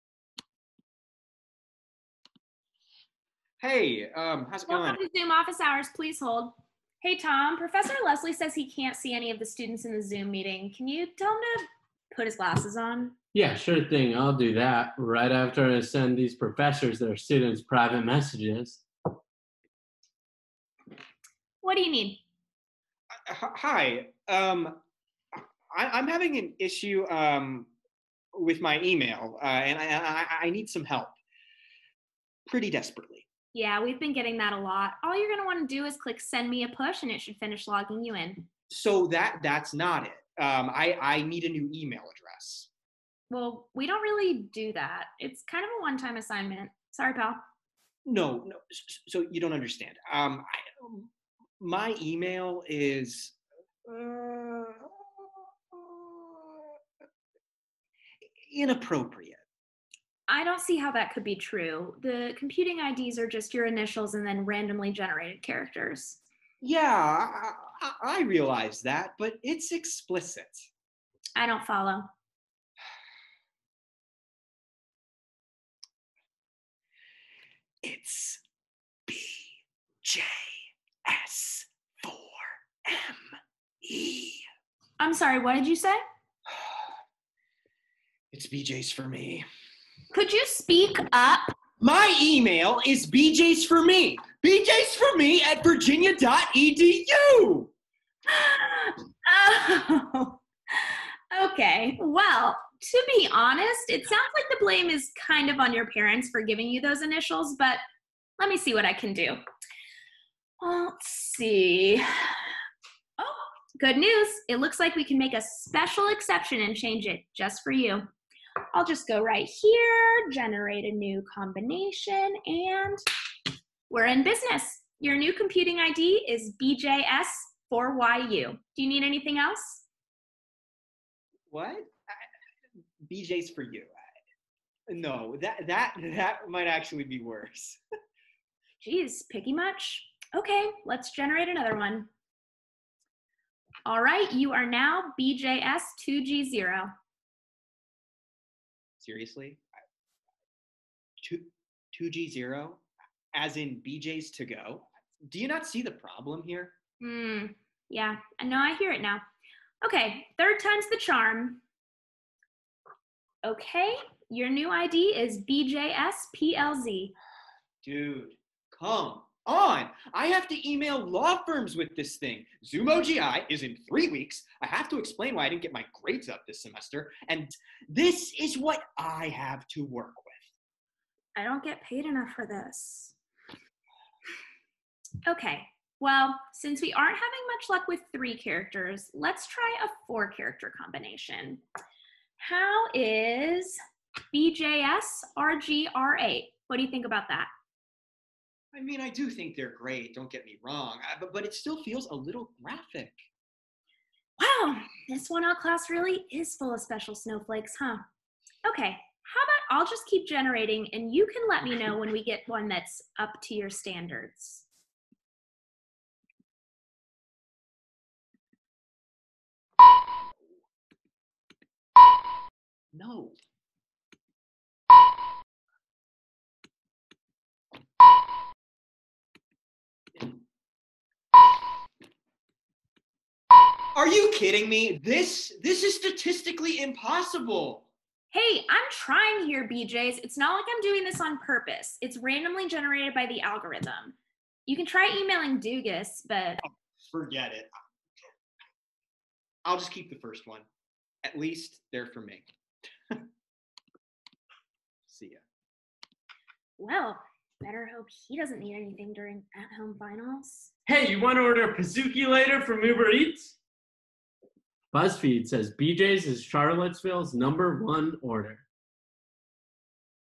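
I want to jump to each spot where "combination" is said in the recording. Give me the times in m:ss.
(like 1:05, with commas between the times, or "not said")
2:01, 3:10.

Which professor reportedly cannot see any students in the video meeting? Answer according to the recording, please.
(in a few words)
Professor Leslie.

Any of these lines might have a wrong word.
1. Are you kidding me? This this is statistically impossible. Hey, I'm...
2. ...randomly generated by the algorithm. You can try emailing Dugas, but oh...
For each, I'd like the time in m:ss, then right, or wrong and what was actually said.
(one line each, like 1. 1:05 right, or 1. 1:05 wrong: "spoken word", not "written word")
1. 3:54 right
2. 4:02 right.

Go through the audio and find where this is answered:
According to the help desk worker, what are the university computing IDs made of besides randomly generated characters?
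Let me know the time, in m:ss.
1:03.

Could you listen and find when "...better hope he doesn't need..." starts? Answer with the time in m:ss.
4:17.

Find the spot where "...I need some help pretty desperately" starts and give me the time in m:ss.
0:30.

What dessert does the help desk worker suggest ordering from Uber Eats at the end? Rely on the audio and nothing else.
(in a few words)
Pizookie.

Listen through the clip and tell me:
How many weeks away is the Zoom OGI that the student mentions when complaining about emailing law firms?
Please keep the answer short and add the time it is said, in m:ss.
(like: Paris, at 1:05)
3, at 2:53.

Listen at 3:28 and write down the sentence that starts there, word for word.
Okay, how about I'll just keep generating, and you can let me know when we get one that's up to your standards.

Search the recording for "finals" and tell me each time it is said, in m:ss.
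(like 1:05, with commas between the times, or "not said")
4:19.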